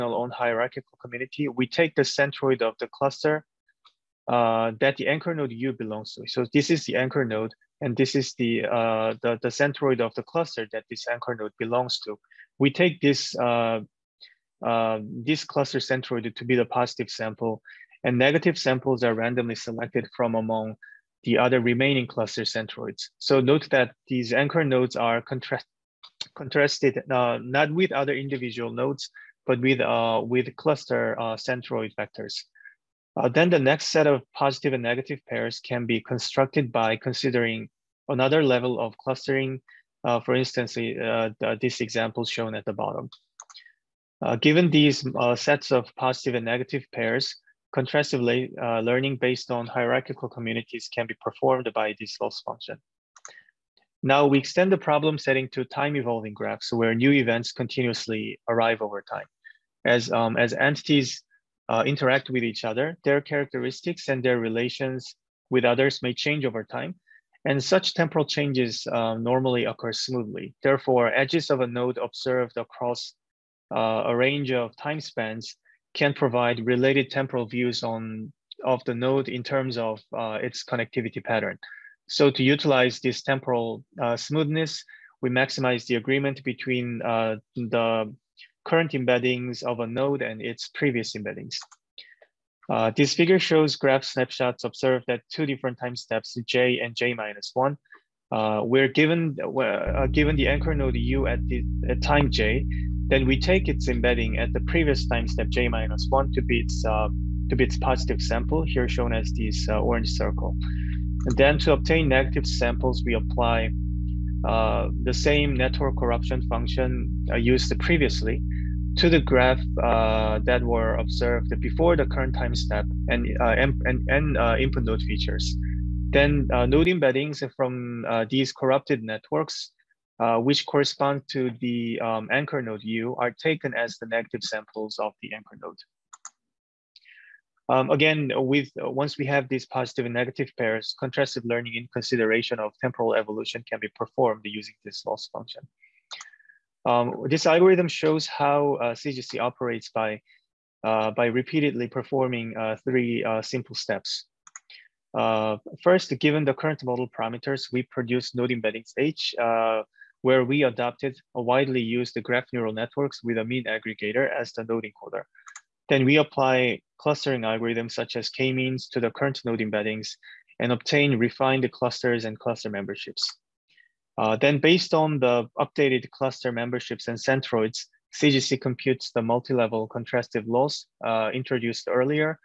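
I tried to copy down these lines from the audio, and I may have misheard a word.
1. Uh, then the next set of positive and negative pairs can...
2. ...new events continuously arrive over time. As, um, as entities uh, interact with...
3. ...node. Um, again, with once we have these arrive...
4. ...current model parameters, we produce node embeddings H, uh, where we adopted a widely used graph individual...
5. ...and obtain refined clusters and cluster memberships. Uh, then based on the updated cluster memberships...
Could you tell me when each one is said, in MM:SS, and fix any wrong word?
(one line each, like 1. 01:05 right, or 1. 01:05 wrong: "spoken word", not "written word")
1. 00:33 right
2. 00:56 right
3. 02:15 wrong: "positive", not "arrive"
4. 02:36 wrong: "neural", not "individual"
5. 02:50 right.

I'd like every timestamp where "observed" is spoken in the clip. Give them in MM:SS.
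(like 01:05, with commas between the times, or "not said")
01:11, 01:34, 02:00.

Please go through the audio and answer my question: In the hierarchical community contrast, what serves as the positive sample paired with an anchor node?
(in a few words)
cluster centroid.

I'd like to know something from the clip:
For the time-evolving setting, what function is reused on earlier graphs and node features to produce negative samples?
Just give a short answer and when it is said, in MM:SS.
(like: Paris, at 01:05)
network corruption function, at 01:55.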